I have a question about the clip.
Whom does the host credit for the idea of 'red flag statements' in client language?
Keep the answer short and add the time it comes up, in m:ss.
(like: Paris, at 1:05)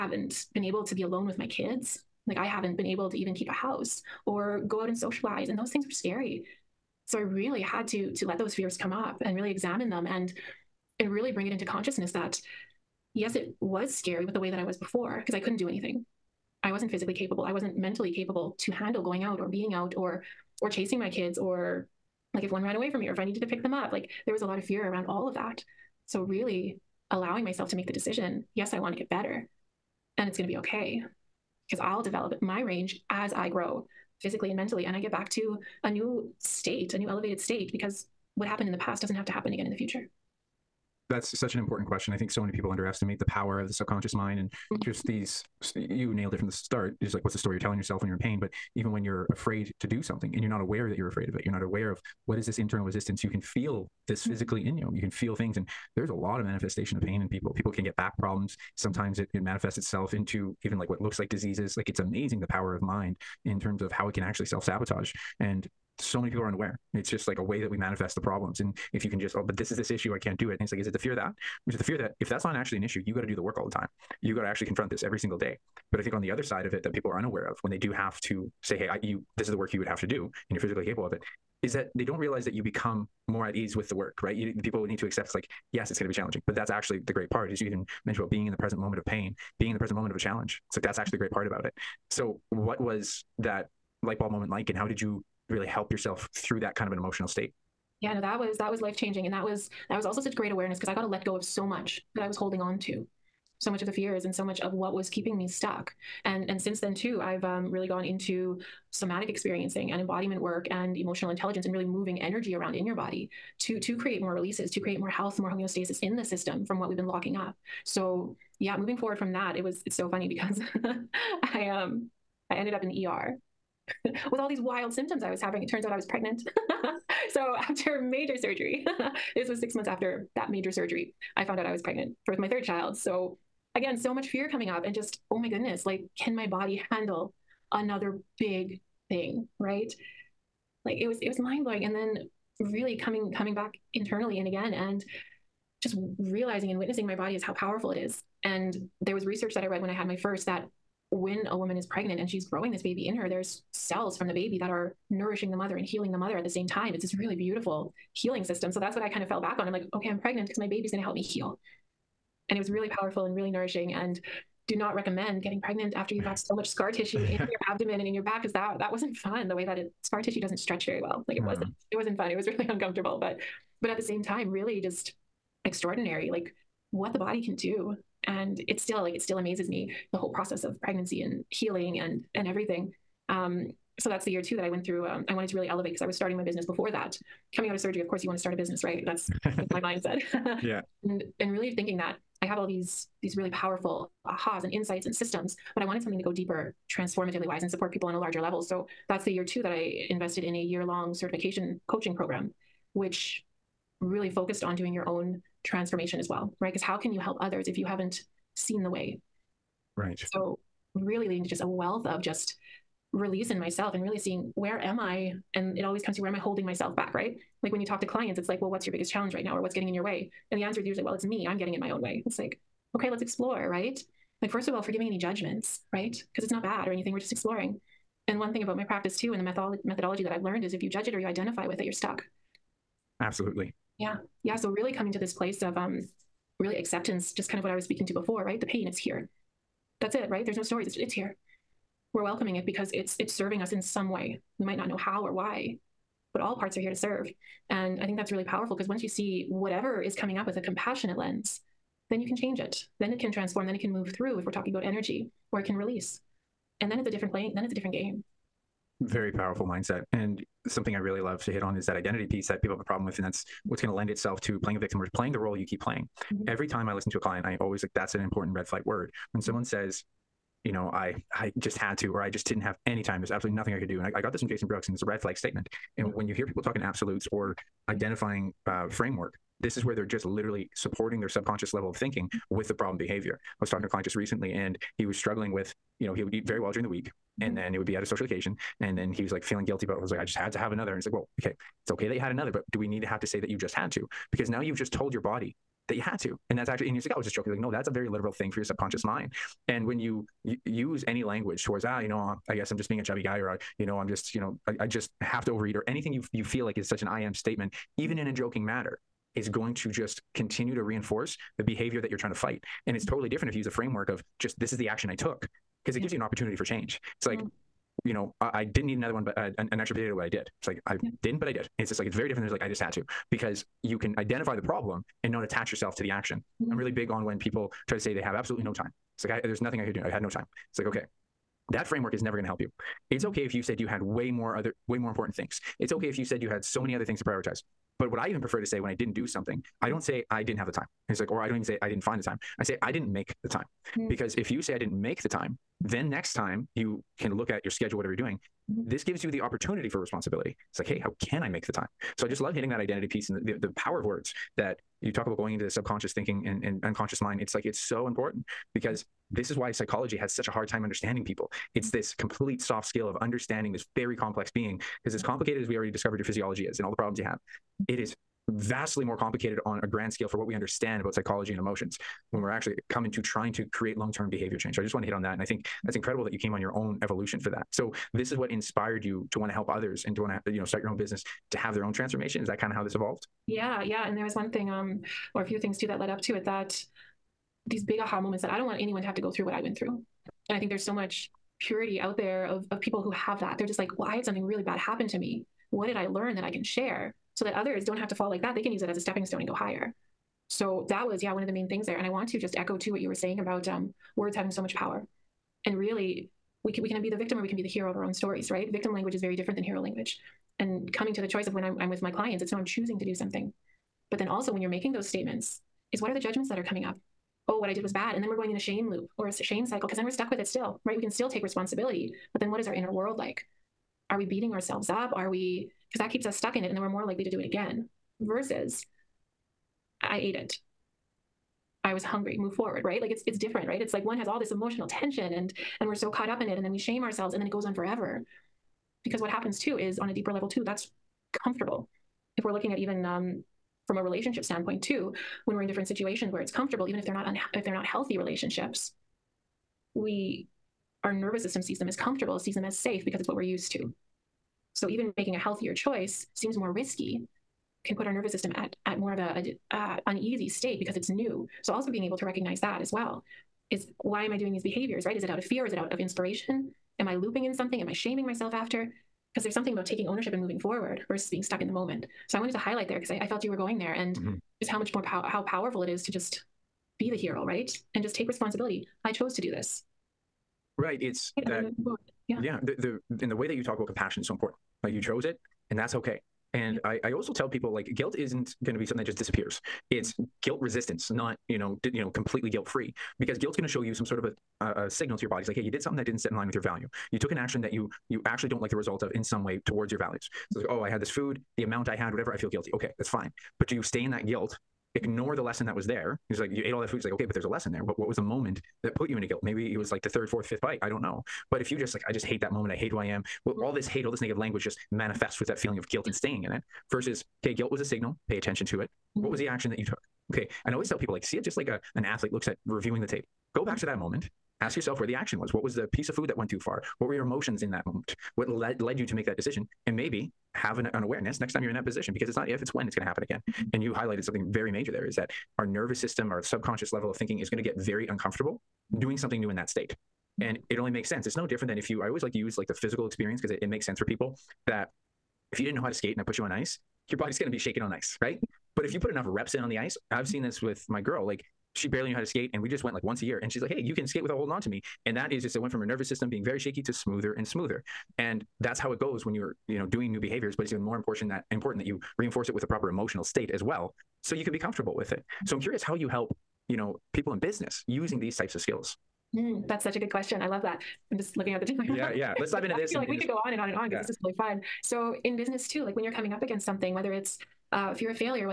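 Jason Brooks, at 4:34.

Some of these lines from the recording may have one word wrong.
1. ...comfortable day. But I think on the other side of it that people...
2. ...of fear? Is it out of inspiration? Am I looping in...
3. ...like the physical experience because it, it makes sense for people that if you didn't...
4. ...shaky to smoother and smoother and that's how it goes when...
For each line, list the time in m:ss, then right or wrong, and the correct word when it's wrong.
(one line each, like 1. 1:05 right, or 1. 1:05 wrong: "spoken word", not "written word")
1. 1:15 wrong: "single", not "comfortable"
2. 7:45 right
3. 9:02 right
4. 9:16 right.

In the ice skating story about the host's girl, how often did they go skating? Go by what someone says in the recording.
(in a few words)
Once a year.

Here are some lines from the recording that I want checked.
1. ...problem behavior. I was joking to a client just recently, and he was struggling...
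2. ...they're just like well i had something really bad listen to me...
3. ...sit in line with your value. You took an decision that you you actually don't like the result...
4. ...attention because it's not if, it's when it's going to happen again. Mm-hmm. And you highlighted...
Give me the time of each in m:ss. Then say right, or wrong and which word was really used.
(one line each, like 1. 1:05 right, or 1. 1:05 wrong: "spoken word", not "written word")
1. 4:42 wrong: "talking", not "joking"
2. 6:33 wrong: "happen", not "listen"
3. 8:16 wrong: "action", not "decision"
4. 8:51 wrong: "position", not "attention".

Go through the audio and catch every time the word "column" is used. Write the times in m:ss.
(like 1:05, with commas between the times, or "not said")
not said.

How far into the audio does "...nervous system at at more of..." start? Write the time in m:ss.
7:38.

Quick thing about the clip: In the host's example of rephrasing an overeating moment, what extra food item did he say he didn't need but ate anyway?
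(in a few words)
Potato.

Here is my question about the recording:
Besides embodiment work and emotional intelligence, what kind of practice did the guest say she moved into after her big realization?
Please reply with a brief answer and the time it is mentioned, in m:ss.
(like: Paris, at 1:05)
Somatic experiencing, at 1:48.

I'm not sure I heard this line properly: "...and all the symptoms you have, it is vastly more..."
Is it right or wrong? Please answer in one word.
wrong.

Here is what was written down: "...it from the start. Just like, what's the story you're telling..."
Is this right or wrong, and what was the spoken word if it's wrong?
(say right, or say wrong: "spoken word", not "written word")
right.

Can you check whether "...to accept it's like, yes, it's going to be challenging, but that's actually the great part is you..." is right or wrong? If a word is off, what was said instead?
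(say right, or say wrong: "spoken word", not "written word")
right.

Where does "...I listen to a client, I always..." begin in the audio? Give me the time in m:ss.
4:26.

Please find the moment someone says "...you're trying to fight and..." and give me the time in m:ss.
5:12.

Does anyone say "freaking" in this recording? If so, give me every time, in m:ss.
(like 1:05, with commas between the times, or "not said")
not said.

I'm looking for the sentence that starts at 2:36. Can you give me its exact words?
It's this really beautiful healing system.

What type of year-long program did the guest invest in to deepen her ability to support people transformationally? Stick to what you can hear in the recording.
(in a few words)
Certification coaching program.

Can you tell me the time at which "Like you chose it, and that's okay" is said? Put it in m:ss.
8:04.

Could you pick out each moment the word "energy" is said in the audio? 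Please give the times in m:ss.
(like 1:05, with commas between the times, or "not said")
1:52, 4:14.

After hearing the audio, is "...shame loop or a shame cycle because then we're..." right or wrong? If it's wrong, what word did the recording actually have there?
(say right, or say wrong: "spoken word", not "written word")
right.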